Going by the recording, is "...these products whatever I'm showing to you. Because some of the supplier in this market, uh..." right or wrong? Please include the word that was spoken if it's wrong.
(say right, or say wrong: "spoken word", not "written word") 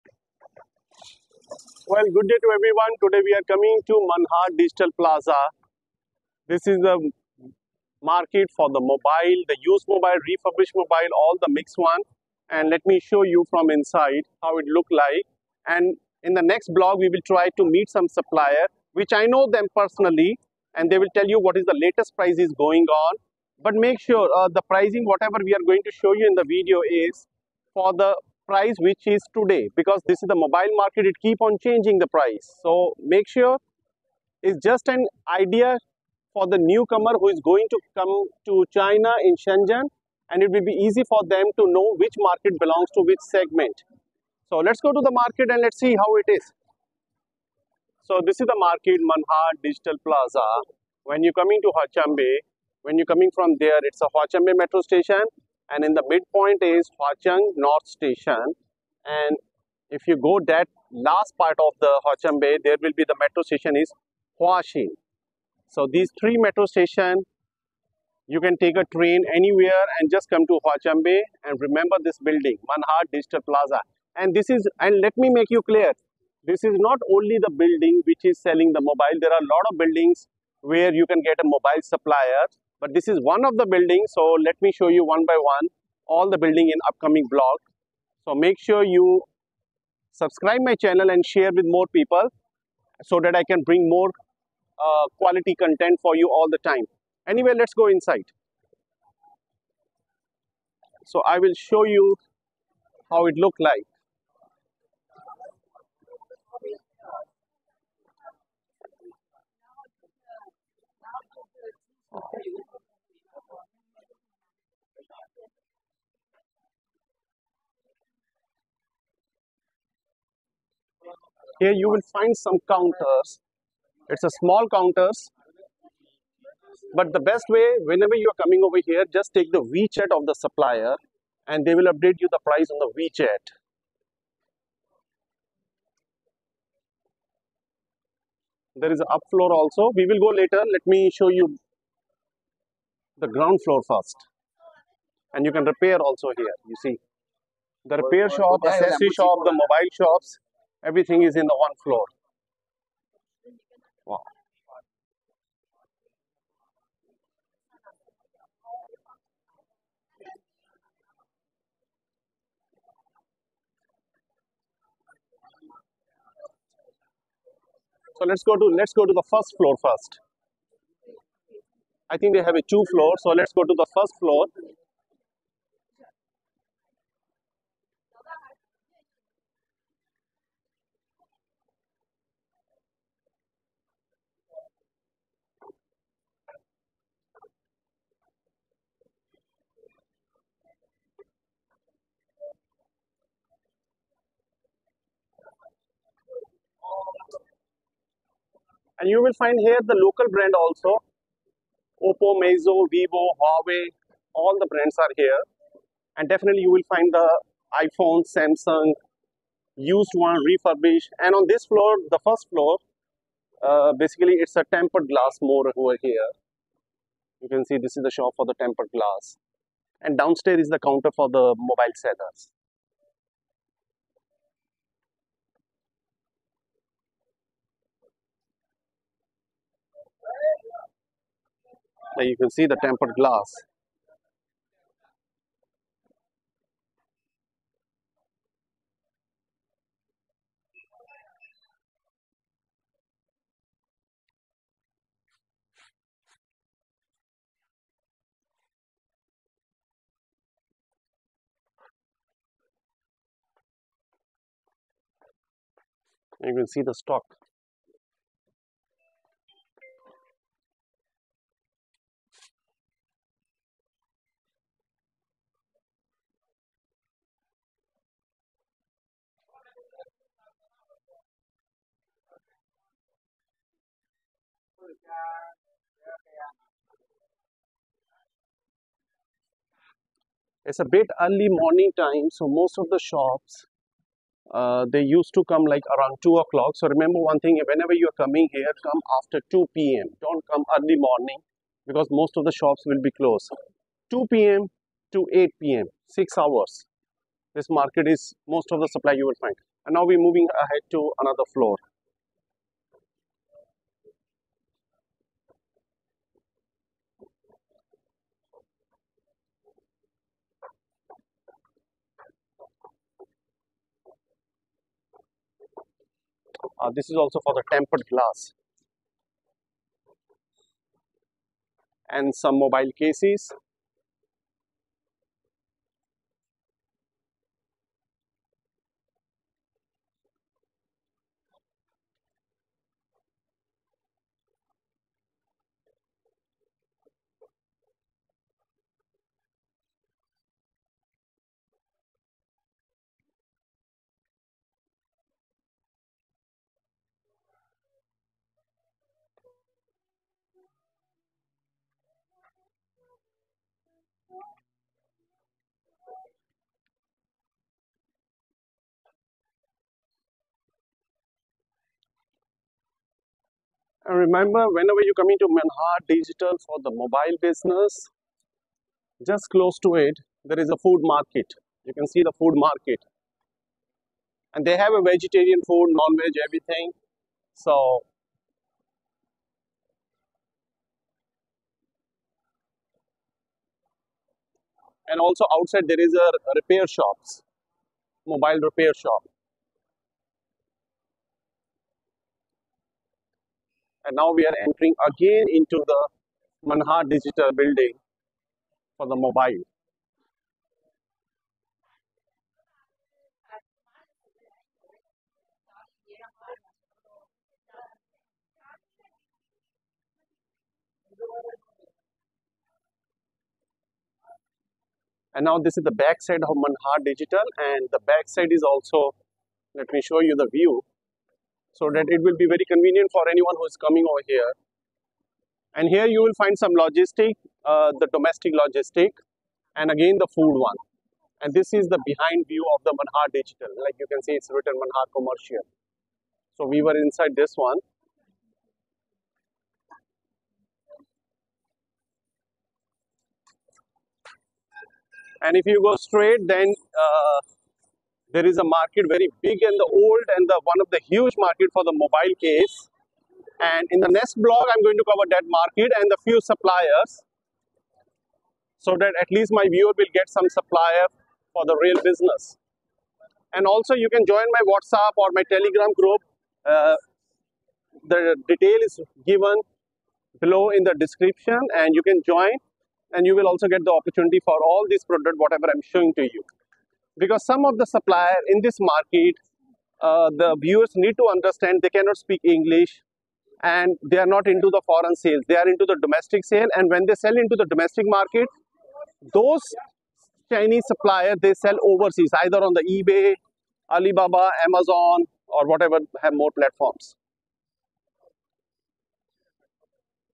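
right.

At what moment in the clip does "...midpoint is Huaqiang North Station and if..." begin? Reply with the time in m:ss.
0:56.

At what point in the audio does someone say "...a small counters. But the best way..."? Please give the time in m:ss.
2:04.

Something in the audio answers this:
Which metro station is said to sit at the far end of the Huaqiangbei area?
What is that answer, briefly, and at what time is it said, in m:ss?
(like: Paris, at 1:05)
Huaxin, at 1:04.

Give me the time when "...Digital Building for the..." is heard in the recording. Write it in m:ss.
6:37.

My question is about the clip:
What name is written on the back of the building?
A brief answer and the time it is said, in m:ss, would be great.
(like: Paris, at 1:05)
Manhar Commercial, at 7:14.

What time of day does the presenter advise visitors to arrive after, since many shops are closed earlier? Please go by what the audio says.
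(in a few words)
2 p.m.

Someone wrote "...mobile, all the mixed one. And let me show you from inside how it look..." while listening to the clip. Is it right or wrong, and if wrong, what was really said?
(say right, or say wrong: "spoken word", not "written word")
right.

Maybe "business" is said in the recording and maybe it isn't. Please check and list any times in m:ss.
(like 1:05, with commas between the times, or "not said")
6:07, 7:42.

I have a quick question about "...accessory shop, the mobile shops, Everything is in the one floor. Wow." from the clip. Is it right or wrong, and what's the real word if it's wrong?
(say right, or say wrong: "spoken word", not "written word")
right.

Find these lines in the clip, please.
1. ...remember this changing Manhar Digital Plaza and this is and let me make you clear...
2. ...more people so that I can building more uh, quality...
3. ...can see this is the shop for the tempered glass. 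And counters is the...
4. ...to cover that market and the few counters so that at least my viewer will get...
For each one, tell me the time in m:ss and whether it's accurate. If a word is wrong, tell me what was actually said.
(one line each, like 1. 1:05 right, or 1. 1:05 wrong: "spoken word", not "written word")
1. 1:11 wrong: "building", not "changing"
2. 1:31 wrong: "bring", not "building"
3. 3:37 wrong: "downstairs", not "counters"
4. 7:35 wrong: "suppliers", not "counters".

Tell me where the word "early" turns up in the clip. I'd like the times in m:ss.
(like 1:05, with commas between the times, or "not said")
4:41, 4:50.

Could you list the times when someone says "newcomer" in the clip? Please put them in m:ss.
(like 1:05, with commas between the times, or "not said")
0:36.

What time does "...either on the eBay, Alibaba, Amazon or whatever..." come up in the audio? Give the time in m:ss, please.
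8:12.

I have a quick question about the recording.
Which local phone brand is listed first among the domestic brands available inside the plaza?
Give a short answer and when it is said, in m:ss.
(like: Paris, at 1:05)
Oppo, at 3:22.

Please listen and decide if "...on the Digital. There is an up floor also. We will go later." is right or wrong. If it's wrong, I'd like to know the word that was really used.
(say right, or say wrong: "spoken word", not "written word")
wrong: "WeChat", not "Digital".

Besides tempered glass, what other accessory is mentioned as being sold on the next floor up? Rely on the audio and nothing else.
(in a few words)
mobile cases.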